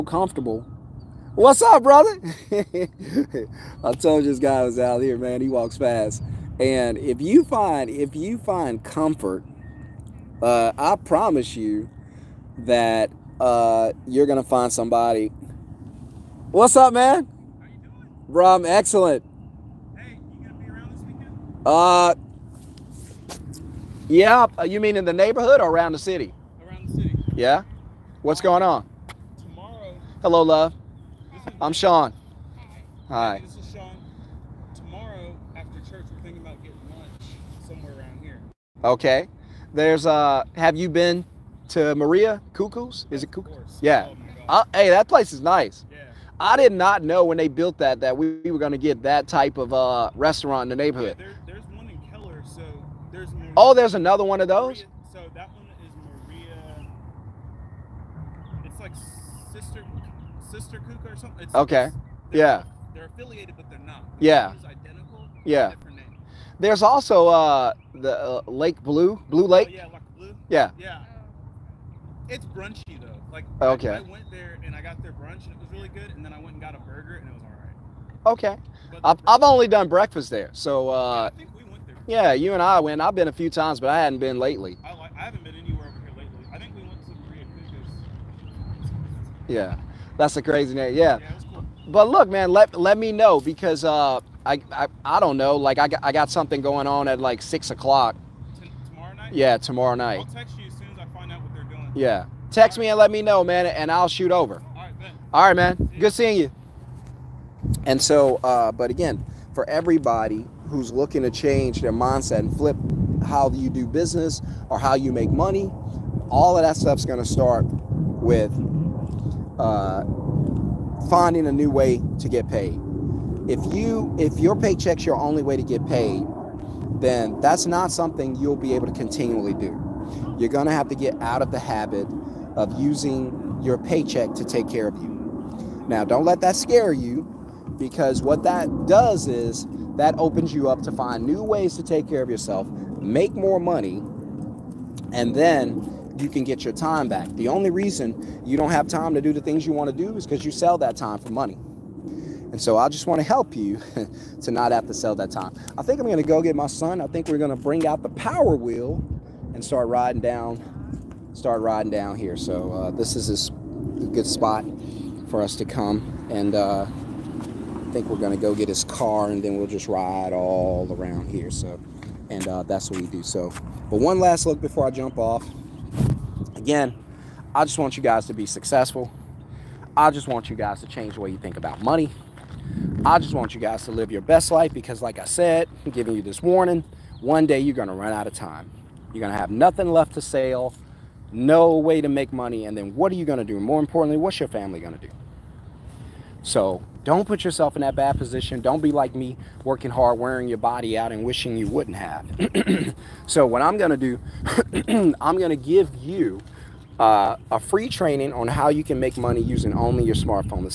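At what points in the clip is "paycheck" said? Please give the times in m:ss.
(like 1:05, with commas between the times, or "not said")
2:04, 2:13.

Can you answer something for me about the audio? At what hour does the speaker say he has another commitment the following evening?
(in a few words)
6.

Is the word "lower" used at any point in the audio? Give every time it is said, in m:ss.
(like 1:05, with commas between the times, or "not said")
not said.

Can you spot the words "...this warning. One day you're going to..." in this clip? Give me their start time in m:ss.
3:06.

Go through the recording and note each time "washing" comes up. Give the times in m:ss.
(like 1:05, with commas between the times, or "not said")
not said.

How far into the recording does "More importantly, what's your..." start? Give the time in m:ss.
3:13.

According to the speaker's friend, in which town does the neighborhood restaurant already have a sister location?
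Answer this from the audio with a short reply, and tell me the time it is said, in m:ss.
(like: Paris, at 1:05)
Keller, at 0:52.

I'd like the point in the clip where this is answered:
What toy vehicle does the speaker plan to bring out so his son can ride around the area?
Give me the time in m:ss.
2:38.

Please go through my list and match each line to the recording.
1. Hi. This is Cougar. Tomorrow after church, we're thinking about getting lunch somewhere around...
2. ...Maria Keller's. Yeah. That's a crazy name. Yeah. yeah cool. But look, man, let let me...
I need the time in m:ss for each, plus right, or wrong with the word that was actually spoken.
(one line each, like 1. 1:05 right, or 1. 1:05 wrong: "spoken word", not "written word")
1. 0:33 wrong: "Sean", not "Cougar"
2. 1:27 wrong: "Cougar", not "Keller".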